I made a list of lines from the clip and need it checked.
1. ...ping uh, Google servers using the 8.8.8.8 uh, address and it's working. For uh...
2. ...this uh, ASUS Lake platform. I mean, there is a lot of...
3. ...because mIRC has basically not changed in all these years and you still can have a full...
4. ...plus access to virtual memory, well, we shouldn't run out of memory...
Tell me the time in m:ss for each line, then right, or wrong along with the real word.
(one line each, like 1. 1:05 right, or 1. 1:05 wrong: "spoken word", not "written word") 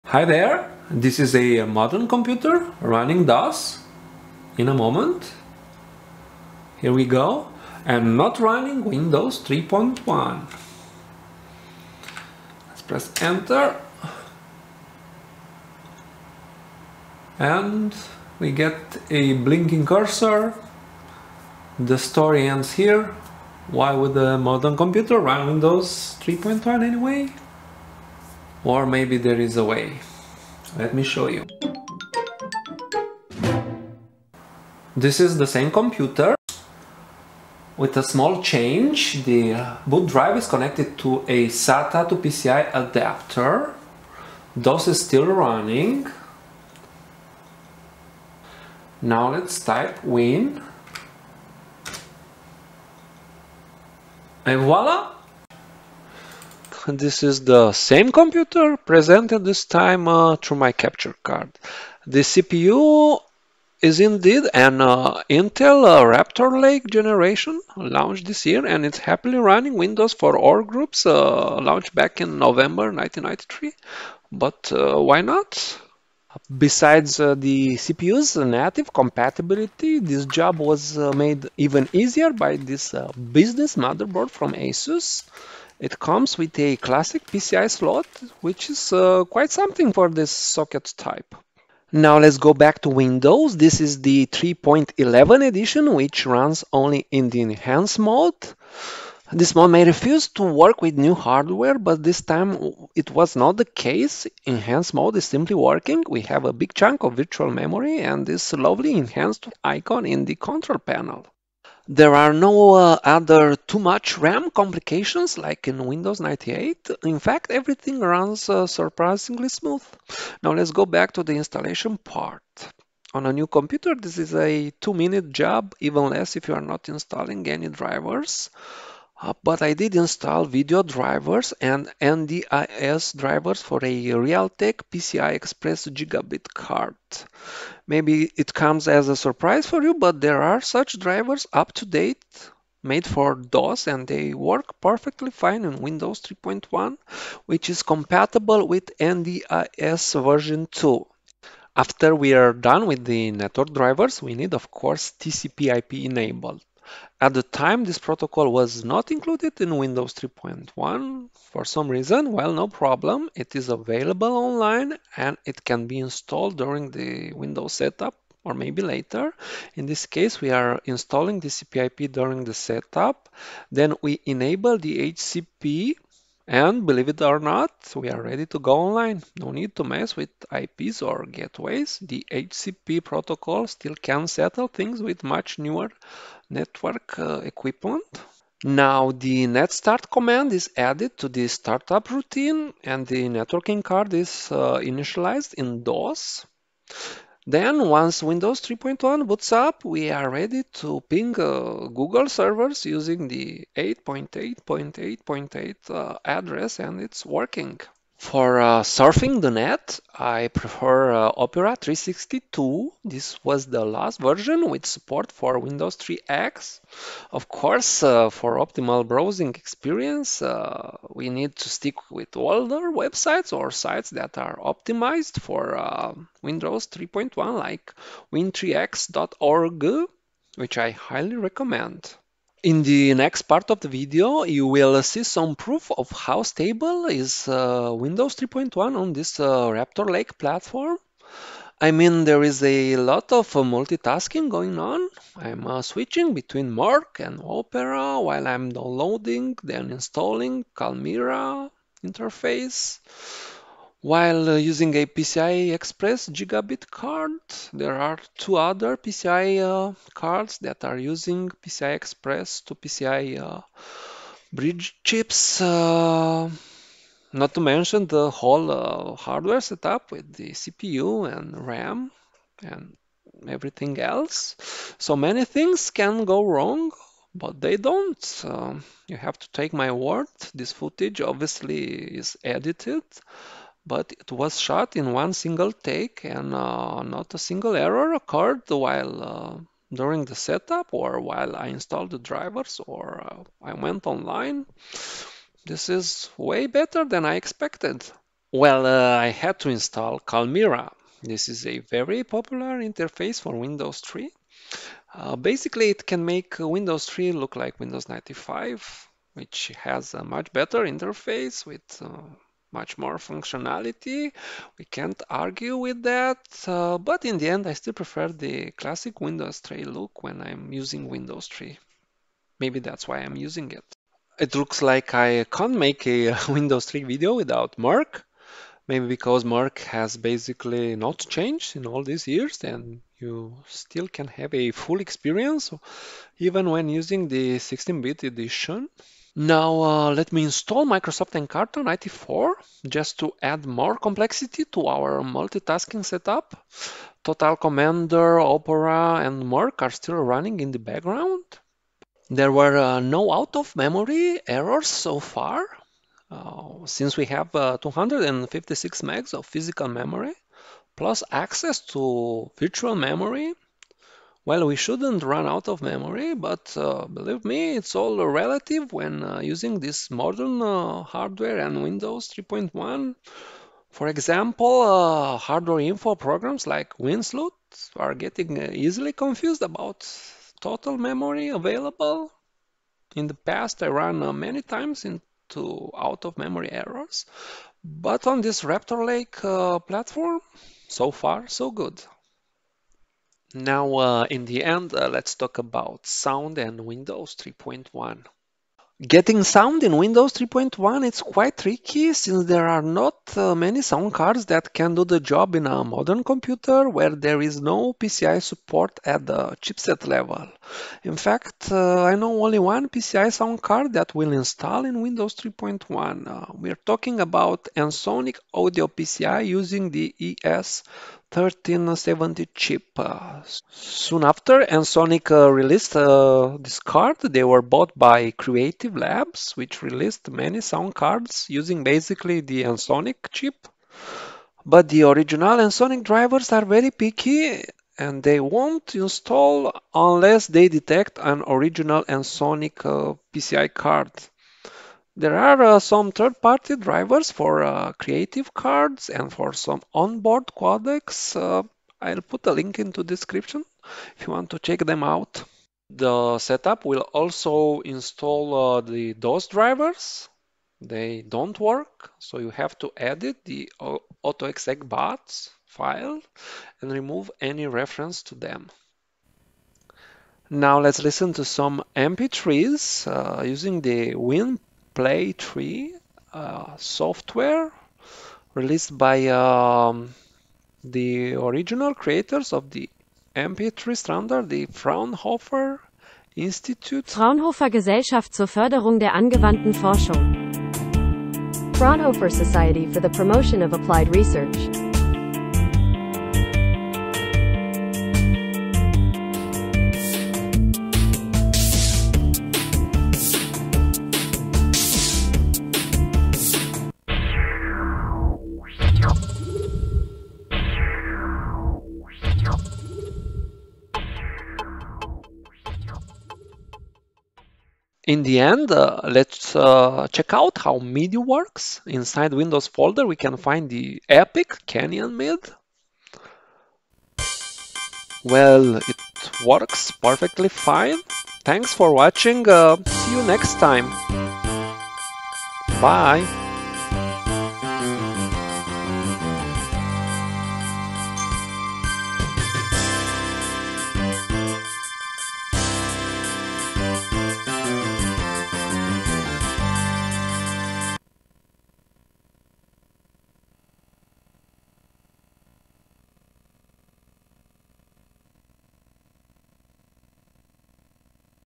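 1. 3:21 right
2. 3:59 wrong: "Raptor", not "ASUS"
3. 5:29 right
4. 6:00 right.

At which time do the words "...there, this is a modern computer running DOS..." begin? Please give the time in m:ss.
0:00.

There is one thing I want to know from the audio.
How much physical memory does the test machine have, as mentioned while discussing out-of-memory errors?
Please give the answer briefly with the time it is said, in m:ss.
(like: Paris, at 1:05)
256 MB, at 5:57.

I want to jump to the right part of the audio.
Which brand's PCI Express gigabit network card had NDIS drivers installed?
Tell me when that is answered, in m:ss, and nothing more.
2:14.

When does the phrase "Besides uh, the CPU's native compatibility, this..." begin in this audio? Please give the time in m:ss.
1:16.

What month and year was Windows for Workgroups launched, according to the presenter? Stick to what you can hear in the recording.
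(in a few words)
November 1993.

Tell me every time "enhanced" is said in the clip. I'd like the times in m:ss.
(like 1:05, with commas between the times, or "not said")
1:37, 1:44, 1:48.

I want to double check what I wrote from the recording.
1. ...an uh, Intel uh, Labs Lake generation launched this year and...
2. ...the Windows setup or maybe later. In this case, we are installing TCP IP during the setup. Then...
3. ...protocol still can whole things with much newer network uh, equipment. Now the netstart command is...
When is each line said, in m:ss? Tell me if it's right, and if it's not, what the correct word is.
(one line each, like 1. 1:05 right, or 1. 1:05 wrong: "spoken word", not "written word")
1. 1:04 wrong: "Raptor", not "Labs"
2. 2:46 right
3. 3:03 wrong: "settle", not "whole".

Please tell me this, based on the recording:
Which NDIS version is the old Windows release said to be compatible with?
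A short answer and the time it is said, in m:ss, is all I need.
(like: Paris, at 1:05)
2, at 2:28.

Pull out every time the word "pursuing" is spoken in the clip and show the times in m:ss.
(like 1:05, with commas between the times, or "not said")
not said.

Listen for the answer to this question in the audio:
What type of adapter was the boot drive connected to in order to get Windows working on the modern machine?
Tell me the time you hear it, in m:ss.
0:41.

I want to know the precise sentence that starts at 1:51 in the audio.
There are no uh, other too much RAM complications like in Windows 98.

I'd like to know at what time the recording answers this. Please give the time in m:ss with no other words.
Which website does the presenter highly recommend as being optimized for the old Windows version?
3:48.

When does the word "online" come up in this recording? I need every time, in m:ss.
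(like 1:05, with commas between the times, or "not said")
2:44, 2:58, 4:54.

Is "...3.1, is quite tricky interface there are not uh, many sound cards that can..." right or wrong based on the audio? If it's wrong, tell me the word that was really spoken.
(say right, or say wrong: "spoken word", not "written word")
wrong: "since", not "interface".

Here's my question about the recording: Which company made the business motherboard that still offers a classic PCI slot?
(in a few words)
ASUS.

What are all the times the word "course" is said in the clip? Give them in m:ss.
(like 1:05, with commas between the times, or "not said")
2:34, 3:37.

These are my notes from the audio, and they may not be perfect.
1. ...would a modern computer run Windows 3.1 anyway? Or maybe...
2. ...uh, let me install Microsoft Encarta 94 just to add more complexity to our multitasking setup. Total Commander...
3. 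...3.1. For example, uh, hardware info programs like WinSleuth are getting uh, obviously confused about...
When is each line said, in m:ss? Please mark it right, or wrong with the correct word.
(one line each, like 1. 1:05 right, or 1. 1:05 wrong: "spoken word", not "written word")
1. 0:23 right
2. 5:39 right
3. 6:12 wrong: "easily", not "obviously".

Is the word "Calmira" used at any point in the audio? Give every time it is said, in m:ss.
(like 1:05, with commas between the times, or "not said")
4:10, 5:00.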